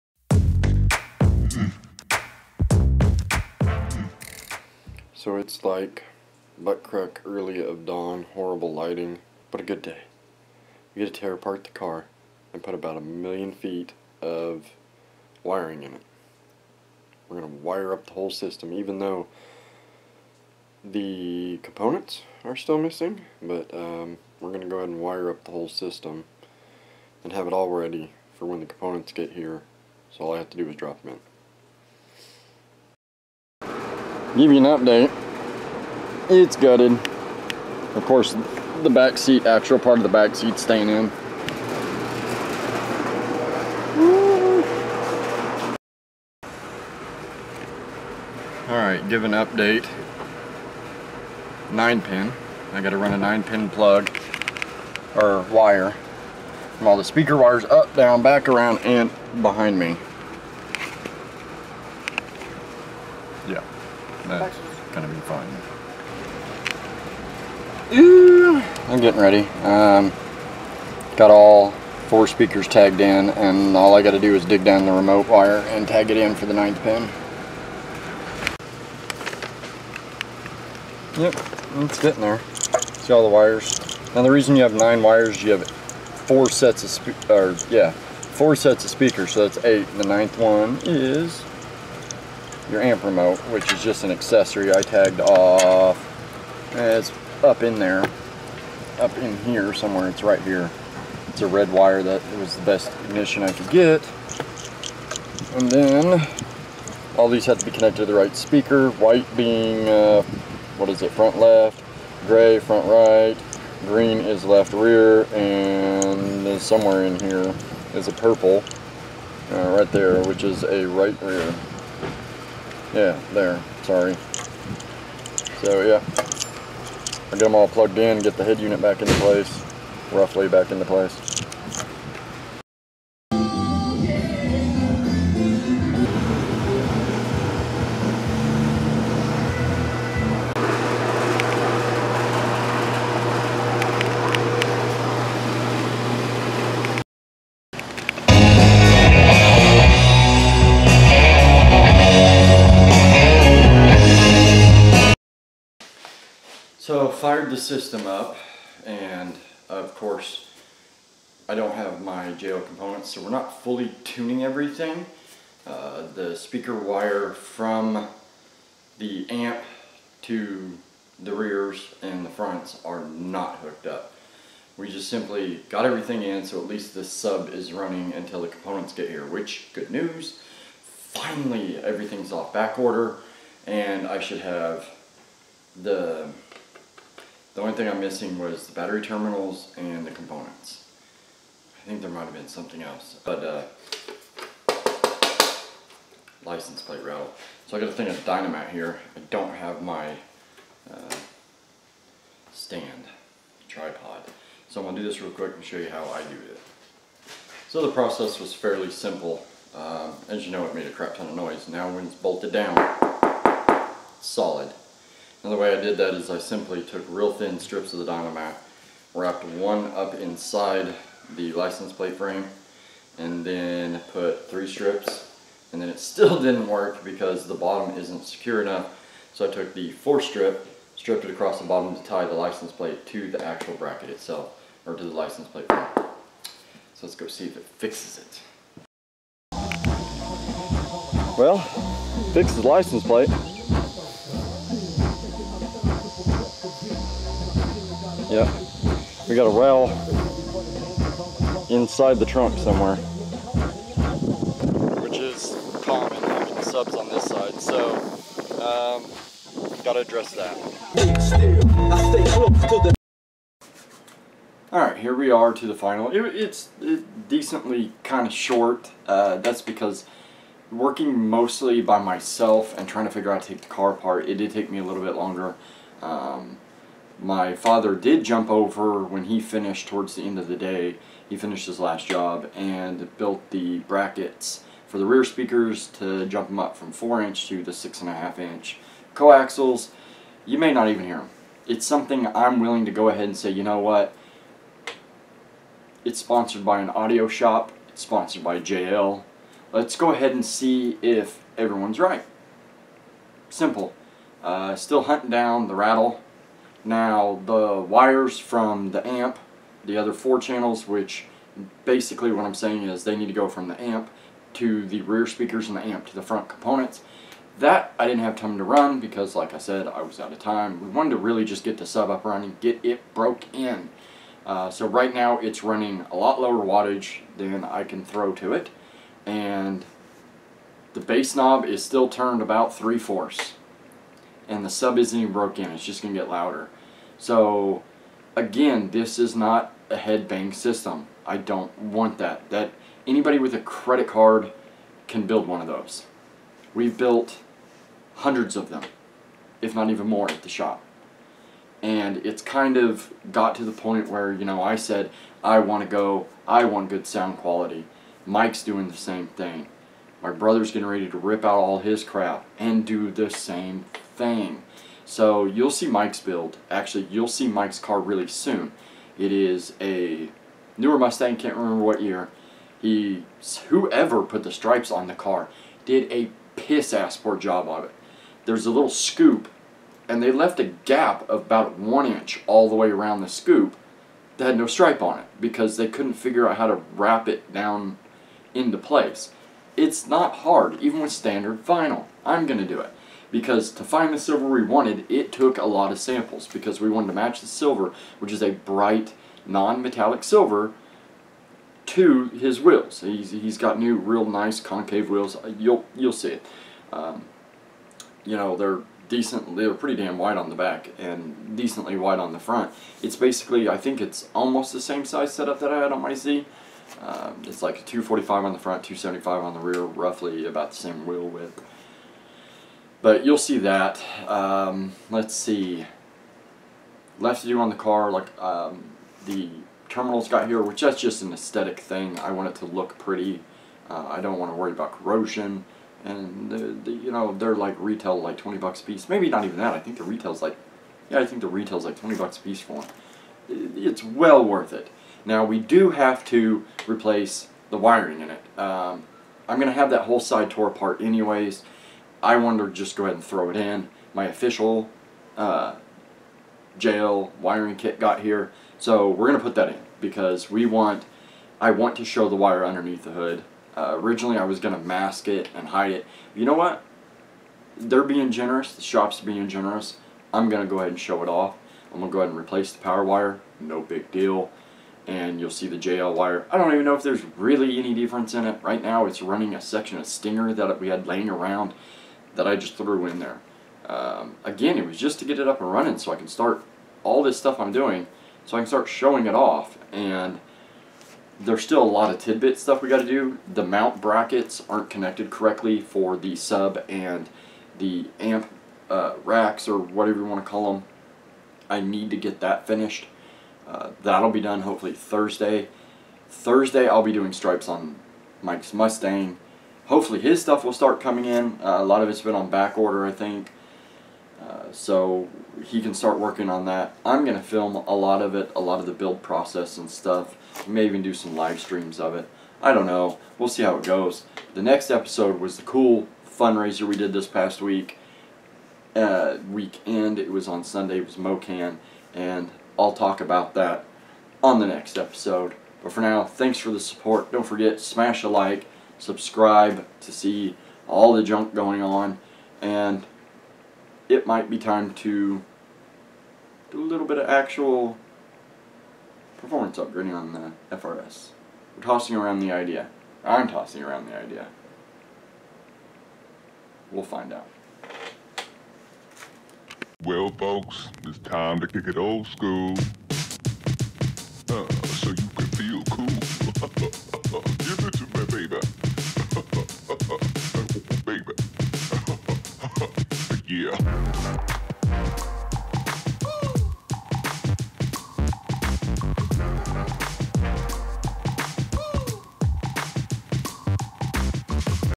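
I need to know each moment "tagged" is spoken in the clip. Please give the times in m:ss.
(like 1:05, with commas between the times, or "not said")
1:12, 1:34.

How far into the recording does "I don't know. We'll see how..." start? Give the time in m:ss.
8:42.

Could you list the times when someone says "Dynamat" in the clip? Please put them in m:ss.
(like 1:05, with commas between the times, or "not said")
3:18, 3:38.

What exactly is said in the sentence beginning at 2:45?
Uh, the speaker wire from the amp to the rears and the fronts are not hooked up.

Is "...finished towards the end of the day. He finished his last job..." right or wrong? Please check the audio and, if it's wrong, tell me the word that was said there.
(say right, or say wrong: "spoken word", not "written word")
right.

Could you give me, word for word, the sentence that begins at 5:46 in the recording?
We've built hundreds of them, if not even more at the shop.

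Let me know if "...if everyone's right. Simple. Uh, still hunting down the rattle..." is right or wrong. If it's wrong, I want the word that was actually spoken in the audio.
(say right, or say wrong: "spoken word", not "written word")
right.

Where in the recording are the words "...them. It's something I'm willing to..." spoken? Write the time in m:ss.
4:51.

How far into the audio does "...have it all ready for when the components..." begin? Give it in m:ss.
0:27.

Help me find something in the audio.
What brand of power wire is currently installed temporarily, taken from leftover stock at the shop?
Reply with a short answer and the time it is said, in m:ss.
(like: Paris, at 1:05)
Stinger, at 8:00.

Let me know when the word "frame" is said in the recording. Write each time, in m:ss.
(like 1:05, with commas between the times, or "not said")
3:42, 3:55.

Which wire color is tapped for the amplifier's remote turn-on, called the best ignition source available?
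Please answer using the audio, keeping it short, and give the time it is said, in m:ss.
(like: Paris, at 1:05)
Red, at 1:41.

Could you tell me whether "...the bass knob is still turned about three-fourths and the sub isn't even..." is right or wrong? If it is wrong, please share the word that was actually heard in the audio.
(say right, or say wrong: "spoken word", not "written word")
right.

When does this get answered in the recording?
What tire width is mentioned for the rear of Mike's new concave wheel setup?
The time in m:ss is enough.
6:58.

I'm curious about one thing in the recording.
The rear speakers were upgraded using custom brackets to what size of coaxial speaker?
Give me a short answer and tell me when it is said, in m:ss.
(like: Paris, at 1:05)
6.5 inch, at 4:47.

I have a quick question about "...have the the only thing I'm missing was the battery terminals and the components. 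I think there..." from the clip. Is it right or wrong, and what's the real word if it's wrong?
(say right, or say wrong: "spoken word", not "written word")
right.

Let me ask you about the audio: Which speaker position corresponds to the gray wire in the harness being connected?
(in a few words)
Front right.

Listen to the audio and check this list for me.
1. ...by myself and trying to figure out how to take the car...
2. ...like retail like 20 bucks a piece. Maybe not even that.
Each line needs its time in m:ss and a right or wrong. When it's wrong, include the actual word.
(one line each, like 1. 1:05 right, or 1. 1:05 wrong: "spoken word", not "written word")
1. 4:31 right
2. 7:17 right.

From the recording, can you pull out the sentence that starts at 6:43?
He's, he's got new, real nice concave wheels.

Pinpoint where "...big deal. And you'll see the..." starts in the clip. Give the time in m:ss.
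7:53.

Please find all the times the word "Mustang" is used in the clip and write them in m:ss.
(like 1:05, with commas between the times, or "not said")
6:10, 8:28.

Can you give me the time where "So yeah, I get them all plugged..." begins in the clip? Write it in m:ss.
2:05.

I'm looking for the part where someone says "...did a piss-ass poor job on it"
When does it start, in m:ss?
6:15.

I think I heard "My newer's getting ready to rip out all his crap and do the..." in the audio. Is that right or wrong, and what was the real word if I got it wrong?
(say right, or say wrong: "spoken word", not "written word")
wrong: "brother", not "newer".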